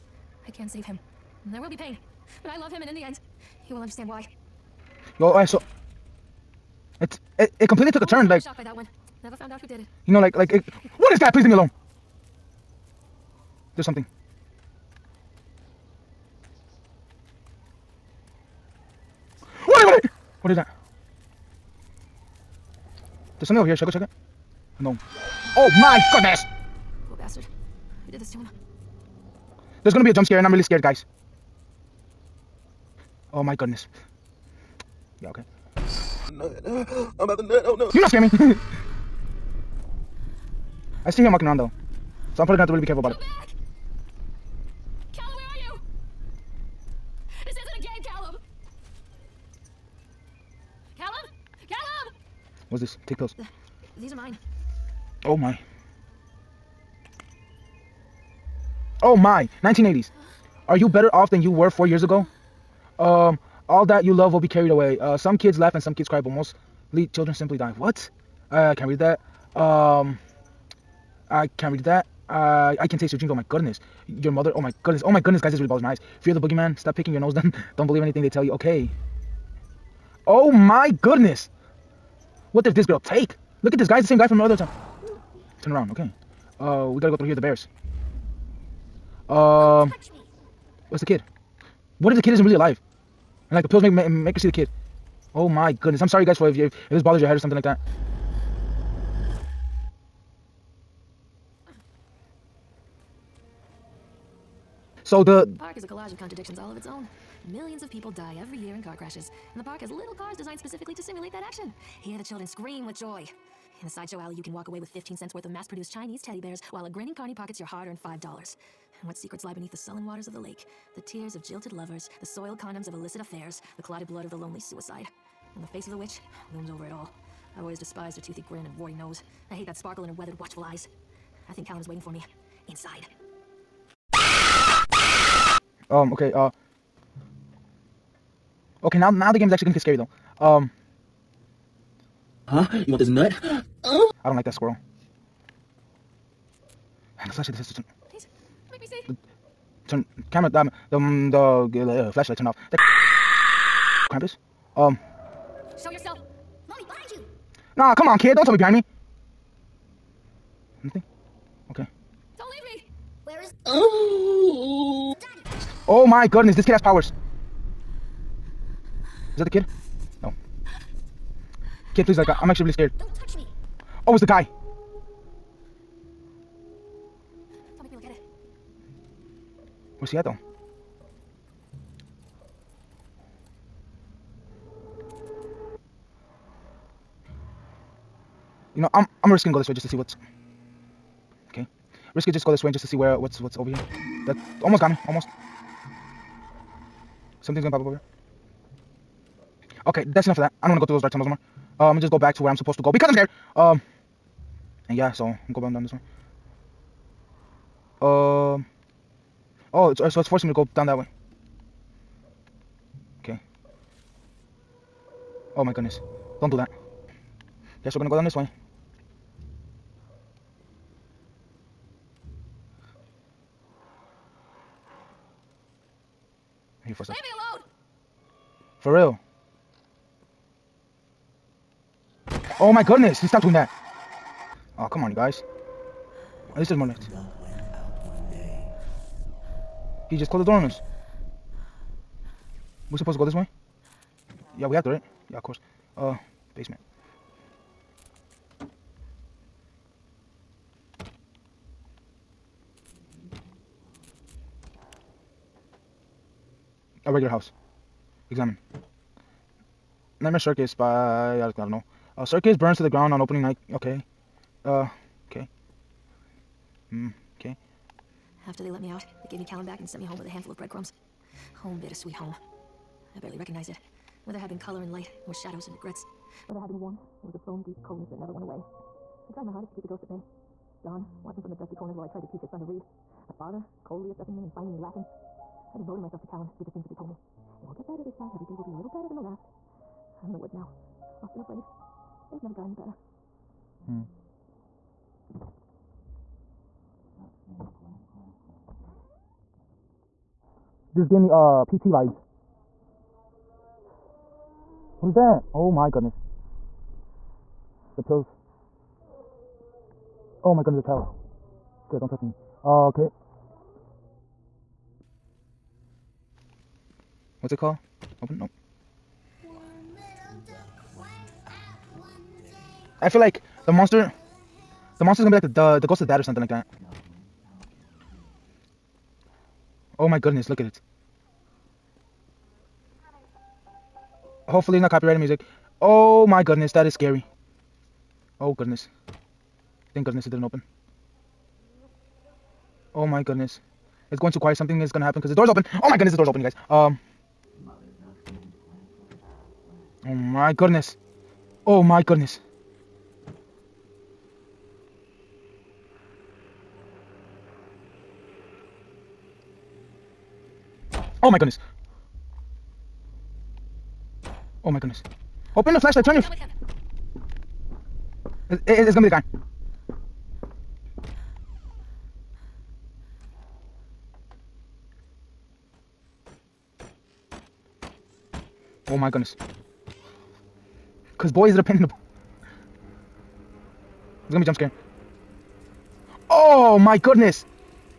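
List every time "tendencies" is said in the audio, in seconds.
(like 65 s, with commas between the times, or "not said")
not said.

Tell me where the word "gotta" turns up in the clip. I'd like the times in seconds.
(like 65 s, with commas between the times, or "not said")
86 s.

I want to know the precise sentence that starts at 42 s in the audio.
So I'm probably gonna have to really be careful about Come it.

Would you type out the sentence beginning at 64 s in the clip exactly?
Uh, some kids laugh and some kids cry, but mostly children simply die.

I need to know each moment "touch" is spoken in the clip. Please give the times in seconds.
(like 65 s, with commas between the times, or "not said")
173 s, 312 s.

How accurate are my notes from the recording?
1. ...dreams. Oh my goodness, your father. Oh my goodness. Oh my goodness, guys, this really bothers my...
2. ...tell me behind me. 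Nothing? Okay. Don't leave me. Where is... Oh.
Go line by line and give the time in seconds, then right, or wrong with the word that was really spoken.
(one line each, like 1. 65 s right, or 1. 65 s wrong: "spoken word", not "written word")
1. 73 s wrong: "mother", not "father"
2. 158 s right.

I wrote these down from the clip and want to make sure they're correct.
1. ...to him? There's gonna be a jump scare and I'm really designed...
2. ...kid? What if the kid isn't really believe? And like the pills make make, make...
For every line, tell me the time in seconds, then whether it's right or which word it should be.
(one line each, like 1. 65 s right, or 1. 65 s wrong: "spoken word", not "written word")
1. 28 s wrong: "scared", not "designed"
2. 91 s wrong: "alive", not "believe".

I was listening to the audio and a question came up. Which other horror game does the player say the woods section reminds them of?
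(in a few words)
PT.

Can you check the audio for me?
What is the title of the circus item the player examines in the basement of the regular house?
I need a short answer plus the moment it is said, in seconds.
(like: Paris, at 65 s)
Nightmare Circus, at 260 s.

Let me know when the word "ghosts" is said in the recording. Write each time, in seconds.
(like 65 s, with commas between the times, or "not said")
279 s, 325 s.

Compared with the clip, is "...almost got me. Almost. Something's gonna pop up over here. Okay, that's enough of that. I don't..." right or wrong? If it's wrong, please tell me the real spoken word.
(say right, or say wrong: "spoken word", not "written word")
right.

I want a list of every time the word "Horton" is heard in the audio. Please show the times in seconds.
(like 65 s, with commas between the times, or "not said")
not said.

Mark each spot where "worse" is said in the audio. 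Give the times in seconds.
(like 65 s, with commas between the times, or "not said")
not said.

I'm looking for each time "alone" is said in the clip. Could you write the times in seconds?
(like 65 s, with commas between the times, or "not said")
11 s, 227 s.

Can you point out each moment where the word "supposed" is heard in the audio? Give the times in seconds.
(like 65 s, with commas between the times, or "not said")
202 s, 242 s.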